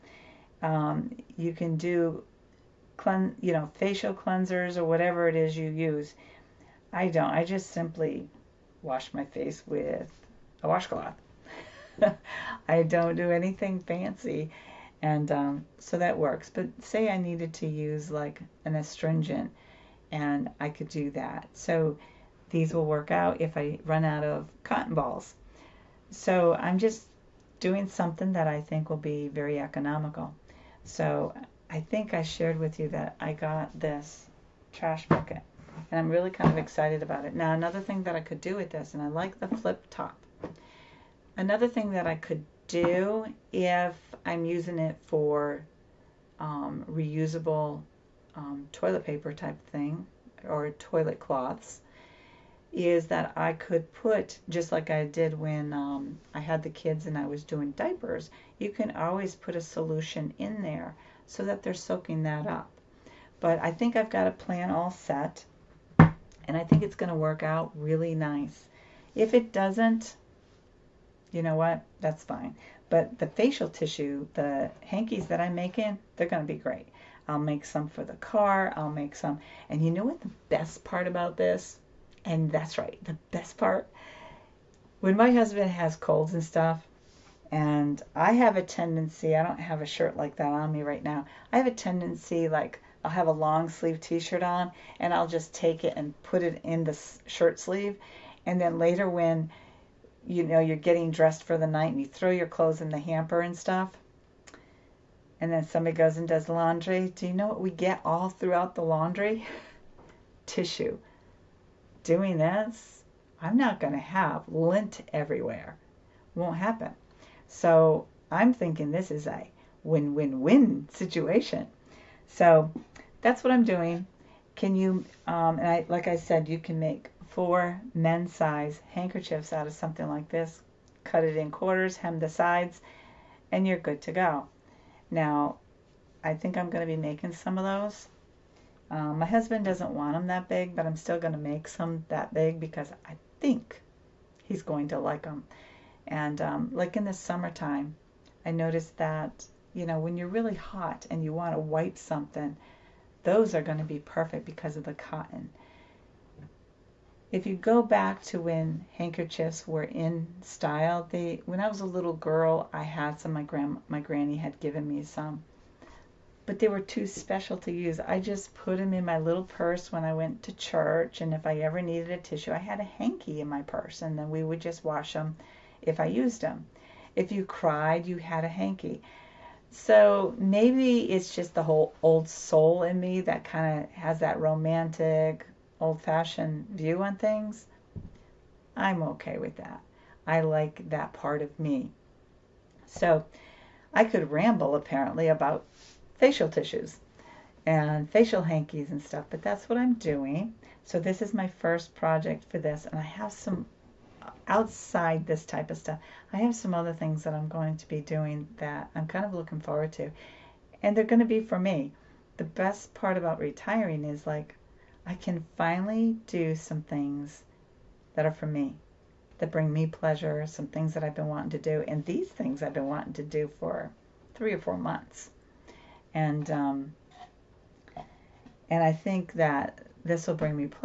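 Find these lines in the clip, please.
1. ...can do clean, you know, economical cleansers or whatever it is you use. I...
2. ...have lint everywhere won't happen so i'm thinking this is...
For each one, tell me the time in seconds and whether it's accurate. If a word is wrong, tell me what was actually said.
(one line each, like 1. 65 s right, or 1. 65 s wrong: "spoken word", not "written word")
1. 1 s wrong: "facial", not "economical"
2. 113 s right.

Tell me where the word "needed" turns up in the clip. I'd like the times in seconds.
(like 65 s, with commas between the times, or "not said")
17 s, 171 s.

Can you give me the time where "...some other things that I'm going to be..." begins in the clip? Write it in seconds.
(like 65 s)
206 s.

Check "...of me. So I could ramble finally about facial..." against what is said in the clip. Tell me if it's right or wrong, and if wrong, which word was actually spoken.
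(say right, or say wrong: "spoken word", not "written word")
wrong: "apparently", not "finally".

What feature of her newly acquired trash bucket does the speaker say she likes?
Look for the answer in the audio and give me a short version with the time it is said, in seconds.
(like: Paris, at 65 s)
flip top, at 39 s.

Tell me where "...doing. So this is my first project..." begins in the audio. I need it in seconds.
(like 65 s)
199 s.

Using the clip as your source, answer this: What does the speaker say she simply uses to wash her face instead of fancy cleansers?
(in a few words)
washcloth.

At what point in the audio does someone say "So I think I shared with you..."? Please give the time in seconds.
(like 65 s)
30 s.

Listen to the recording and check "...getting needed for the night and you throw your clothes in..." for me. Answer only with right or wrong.
wrong.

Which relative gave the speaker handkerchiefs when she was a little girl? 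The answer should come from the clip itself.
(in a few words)
granny.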